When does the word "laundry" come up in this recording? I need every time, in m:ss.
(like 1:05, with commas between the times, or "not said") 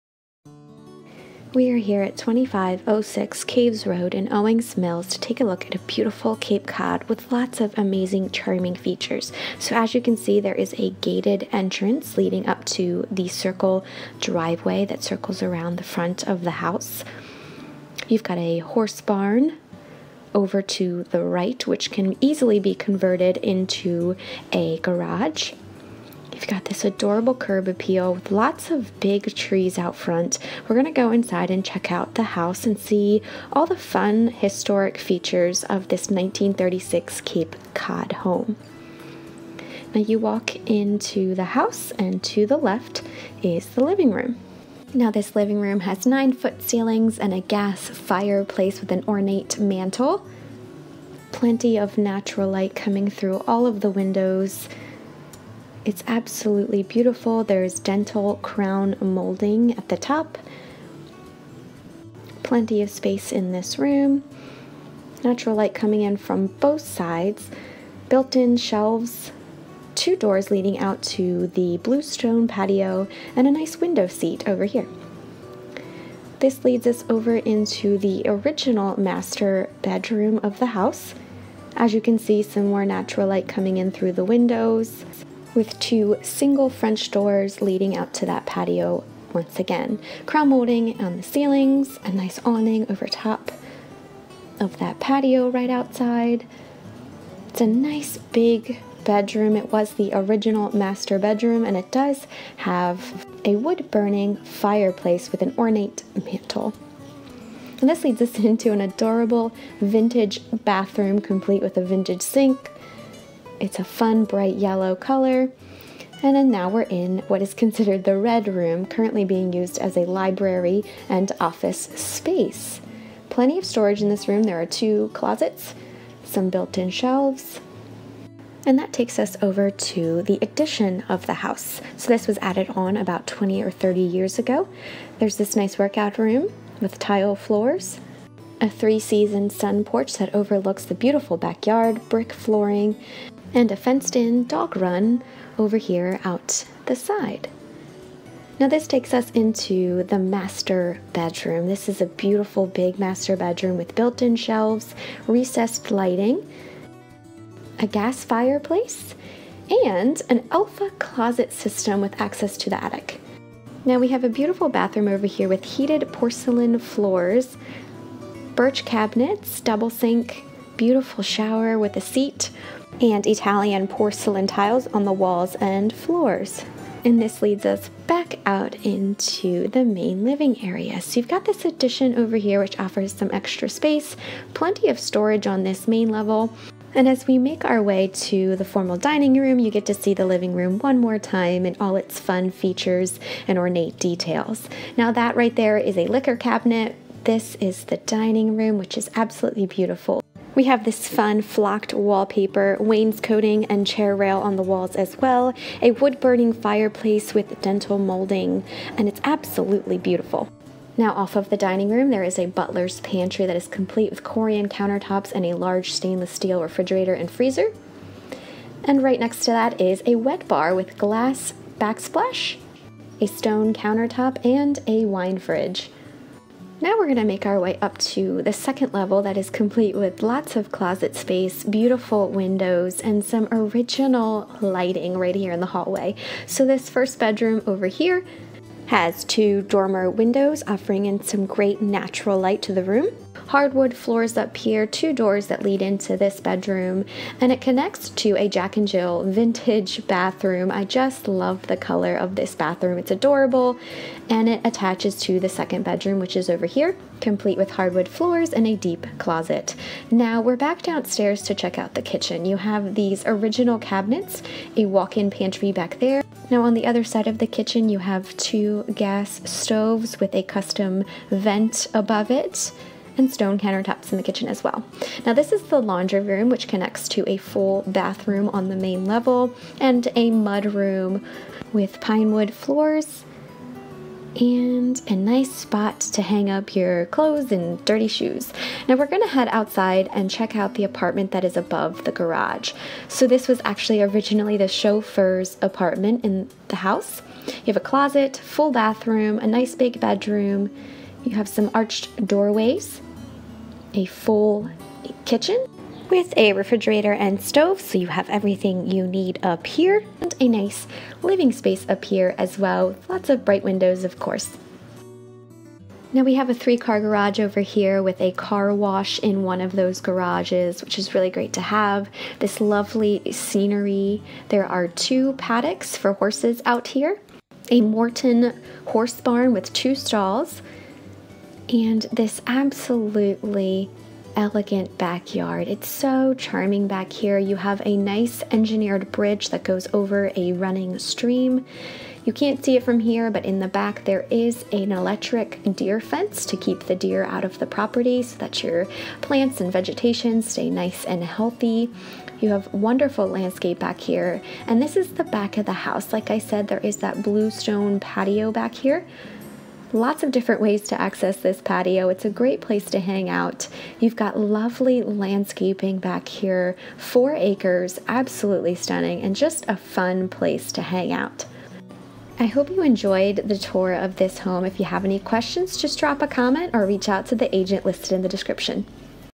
4:35.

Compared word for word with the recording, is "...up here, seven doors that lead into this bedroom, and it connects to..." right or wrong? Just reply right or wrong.
wrong.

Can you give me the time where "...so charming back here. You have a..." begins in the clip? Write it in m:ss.
5:35.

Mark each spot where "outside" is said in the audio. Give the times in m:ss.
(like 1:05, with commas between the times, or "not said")
1:35, 4:49.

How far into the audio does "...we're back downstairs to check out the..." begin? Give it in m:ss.
4:20.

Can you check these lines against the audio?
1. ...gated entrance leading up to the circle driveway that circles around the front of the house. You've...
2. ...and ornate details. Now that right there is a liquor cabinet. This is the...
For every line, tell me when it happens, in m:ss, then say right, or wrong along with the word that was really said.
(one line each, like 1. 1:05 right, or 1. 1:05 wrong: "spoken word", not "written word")
1. 0:11 right
2. 3:13 right.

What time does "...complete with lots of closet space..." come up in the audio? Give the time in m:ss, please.
3:49.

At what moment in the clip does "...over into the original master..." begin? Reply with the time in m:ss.
1:17.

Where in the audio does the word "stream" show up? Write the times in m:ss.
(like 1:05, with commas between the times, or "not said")
5:40.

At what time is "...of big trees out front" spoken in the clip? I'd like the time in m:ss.
0:28.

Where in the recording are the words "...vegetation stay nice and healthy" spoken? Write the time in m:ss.
5:49.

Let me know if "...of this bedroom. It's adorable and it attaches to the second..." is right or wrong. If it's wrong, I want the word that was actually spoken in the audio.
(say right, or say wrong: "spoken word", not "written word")
wrong: "bathroom", not "bedroom".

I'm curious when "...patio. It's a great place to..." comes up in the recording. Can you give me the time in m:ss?
6:01.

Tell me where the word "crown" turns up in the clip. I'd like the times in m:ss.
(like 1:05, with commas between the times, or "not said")
0:58, 1:30.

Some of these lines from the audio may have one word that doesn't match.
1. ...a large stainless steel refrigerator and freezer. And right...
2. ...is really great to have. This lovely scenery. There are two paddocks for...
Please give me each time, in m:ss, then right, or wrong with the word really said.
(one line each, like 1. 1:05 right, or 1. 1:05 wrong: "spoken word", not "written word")
1. 3:35 right
2. 5:20 right.